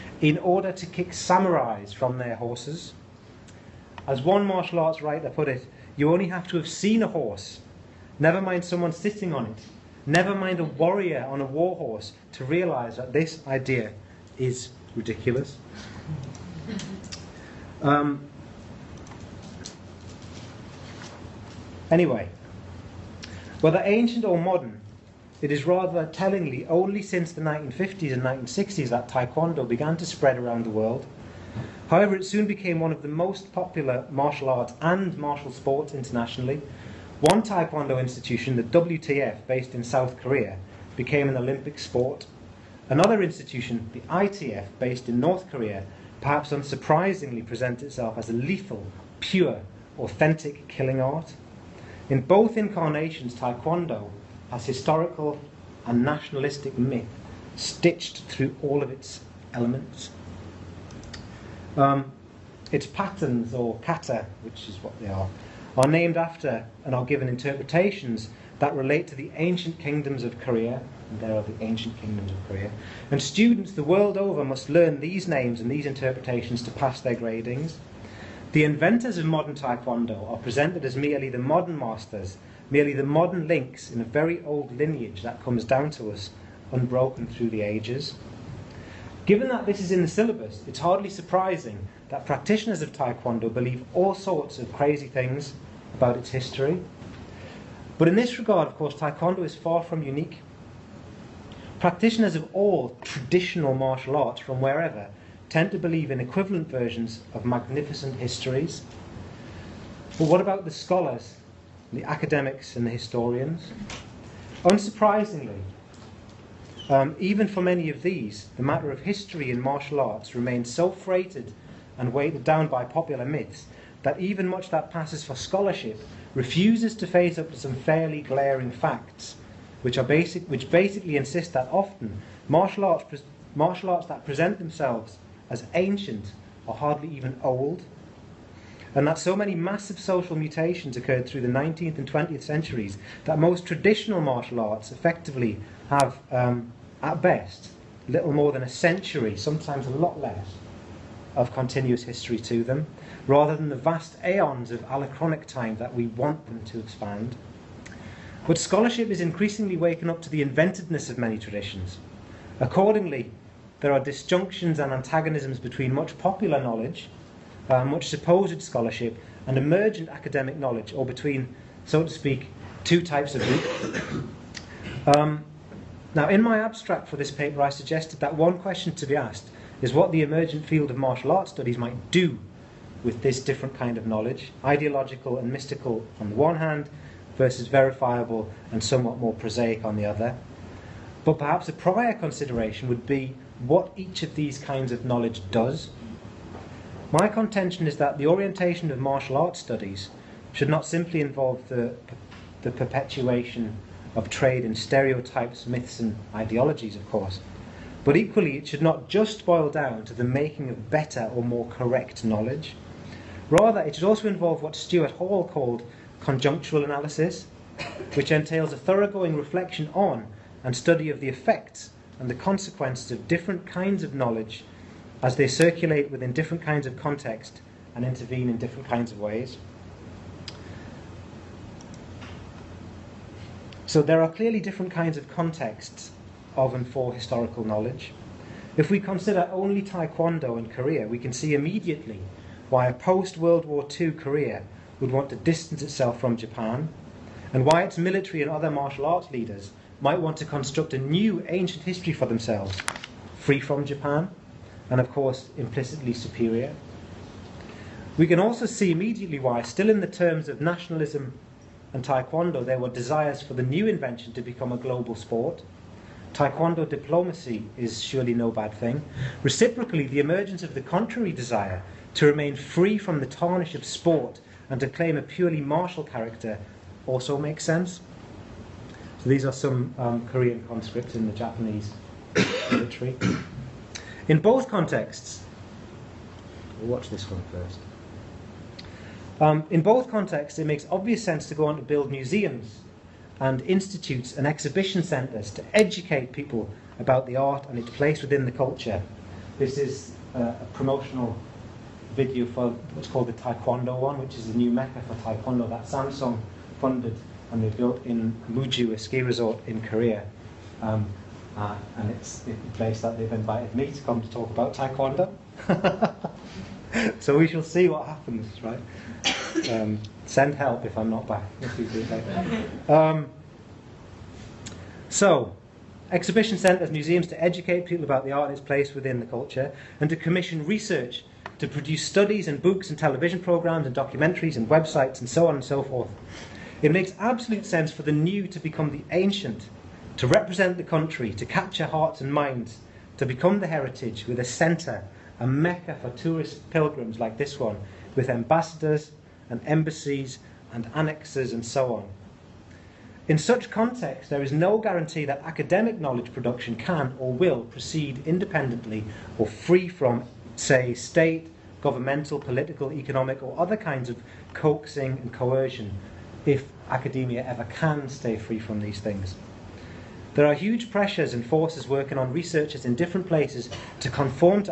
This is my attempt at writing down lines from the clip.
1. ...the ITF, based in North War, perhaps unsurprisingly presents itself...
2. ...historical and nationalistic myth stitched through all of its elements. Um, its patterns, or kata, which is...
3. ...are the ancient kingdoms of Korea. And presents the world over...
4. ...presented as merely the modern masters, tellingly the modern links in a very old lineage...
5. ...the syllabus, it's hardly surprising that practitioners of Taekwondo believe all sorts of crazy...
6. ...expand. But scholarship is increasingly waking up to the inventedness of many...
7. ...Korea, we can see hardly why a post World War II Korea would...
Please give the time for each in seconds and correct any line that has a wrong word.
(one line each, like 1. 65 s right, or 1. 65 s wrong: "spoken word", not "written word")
1. 43 s wrong: "Korea", not "War"
2. 54 s right
3. 71 s wrong: "students", not "presents"
4. 80 s wrong: "merely", not "tellingly"
5. 90 s right
6. 156 s right
7. 240 s wrong: "immediately", not "hardly".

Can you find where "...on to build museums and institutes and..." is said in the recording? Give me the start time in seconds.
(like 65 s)
291 s.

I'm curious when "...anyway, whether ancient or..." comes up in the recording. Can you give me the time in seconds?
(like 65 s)
21 s.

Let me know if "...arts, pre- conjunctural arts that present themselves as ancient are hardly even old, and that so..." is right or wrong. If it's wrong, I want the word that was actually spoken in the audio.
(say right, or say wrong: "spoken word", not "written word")
wrong: "martial", not "conjunctural".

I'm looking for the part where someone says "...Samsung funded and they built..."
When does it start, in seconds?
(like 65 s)
305 s.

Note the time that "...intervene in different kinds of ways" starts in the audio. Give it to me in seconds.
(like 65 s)
228 s.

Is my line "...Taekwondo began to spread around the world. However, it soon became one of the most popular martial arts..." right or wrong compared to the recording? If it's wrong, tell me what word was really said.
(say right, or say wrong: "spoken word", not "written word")
right.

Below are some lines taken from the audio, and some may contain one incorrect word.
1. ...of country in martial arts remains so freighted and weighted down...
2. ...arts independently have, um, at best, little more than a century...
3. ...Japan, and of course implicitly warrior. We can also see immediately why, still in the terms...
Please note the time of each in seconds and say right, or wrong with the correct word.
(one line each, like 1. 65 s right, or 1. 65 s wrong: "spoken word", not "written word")
1. 118 s wrong: "history", not "country"
2. 144 s wrong: "effectively", not "independently"
3. 253 s wrong: "superior", not "warrior".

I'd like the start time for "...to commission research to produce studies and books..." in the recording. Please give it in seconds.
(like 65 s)
330 s.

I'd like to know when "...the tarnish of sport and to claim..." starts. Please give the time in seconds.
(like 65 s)
273 s.